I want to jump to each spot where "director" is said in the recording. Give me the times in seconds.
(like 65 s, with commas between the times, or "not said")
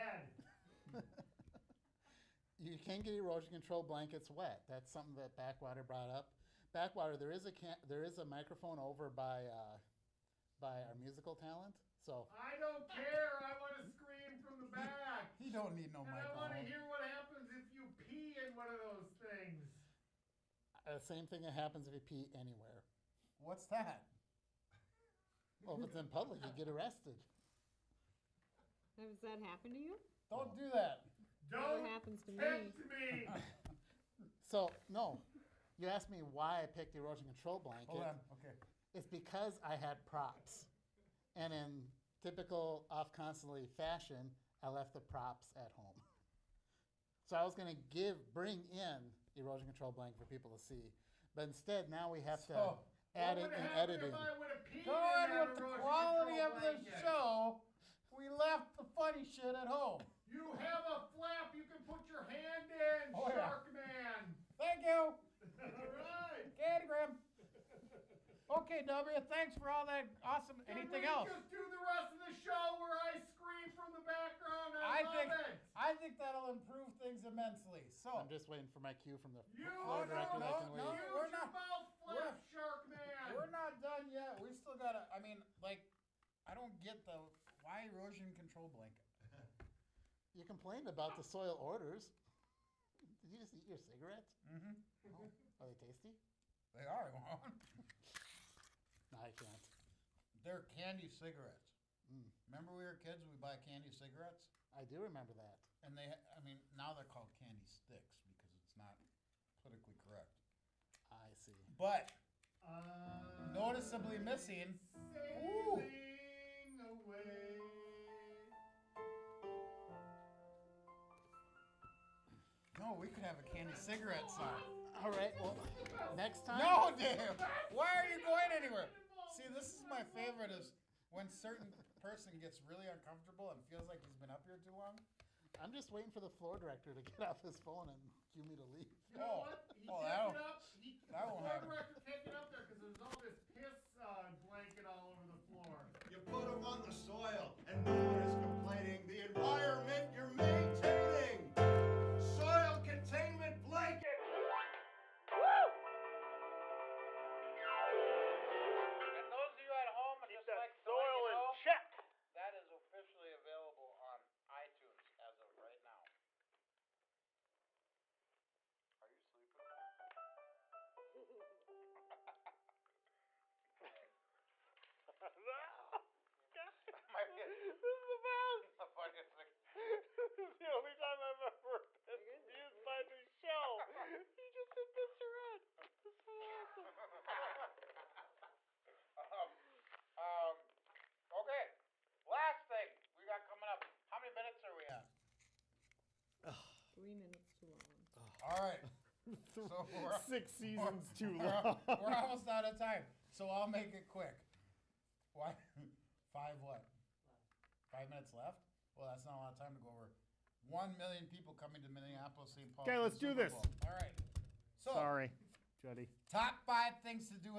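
80 s, 136 s, 141 s.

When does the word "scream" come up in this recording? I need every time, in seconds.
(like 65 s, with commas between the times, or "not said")
13 s, 73 s.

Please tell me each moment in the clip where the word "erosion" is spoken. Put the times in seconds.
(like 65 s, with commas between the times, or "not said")
3 s, 36 s, 49 s, 87 s.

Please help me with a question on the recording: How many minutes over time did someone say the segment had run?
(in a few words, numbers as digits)
3 minutes.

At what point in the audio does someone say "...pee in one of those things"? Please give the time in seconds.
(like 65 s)
17 s.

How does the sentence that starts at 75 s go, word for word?
I think that'll improve things immensely.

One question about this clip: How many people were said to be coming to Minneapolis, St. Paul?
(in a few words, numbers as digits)
1 million.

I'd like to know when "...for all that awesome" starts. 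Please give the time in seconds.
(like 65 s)
69 s.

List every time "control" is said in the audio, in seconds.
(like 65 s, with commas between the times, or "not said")
3 s, 37 s, 49 s, 88 s.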